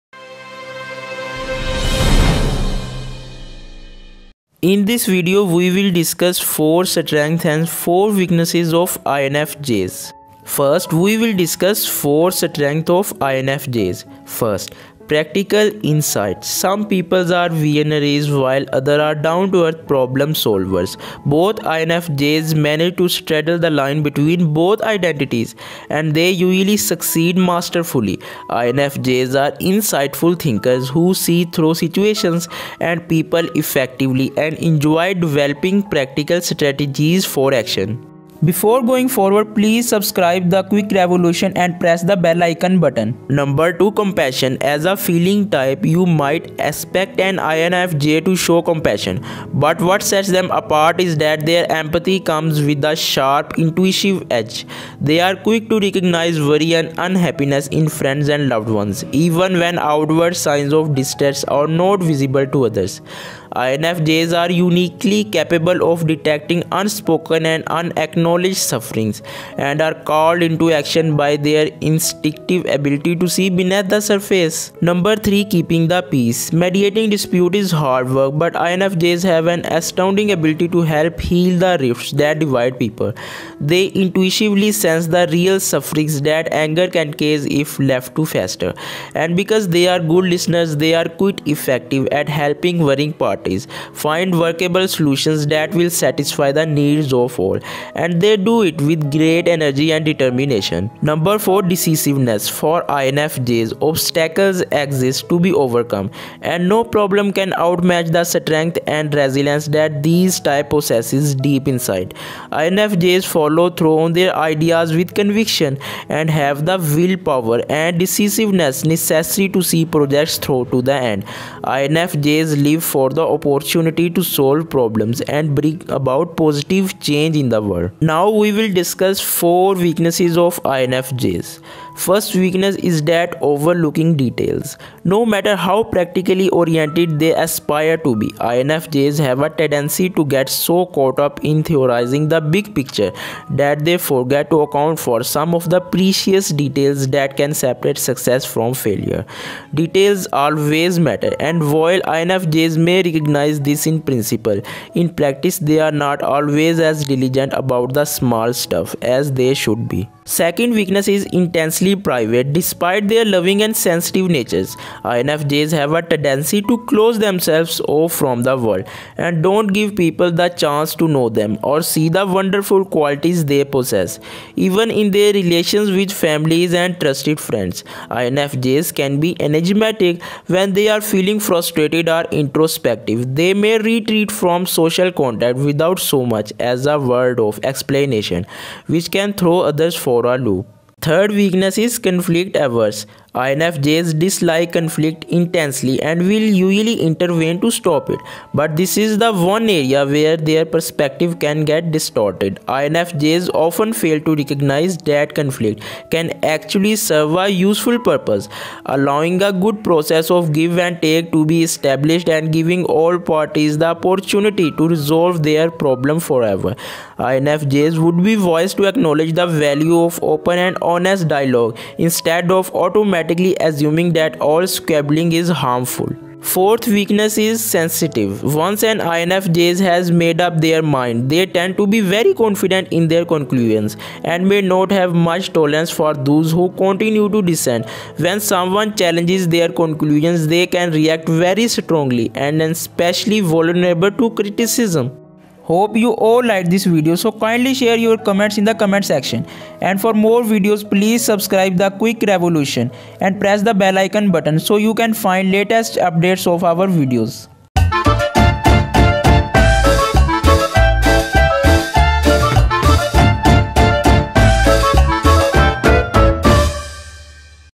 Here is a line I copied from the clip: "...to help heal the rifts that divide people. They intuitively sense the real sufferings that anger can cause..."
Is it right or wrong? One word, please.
right.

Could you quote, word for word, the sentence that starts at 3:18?
But this is the one area where their perspective can get distorted.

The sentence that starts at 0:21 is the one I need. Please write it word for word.
Both INFJs manage to straddle the line between both identities and they usually succeed masterfully.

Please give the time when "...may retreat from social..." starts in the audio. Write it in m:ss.
3:03.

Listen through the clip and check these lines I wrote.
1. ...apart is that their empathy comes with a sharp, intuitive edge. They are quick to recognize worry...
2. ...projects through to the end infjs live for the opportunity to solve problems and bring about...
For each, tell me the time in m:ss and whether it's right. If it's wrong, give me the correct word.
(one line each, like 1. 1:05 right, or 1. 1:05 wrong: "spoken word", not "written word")
1. 0:50 right
2. 1:59 right.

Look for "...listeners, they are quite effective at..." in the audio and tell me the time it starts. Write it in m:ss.
1:30.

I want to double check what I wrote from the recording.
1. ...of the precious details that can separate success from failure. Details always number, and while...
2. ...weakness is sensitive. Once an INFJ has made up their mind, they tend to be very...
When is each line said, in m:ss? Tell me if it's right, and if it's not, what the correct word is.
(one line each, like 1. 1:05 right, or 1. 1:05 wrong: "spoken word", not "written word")
1. 2:25 wrong: "matter", not "number"
2. 3:46 right.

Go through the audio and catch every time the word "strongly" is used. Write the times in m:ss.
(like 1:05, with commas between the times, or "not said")
4:01.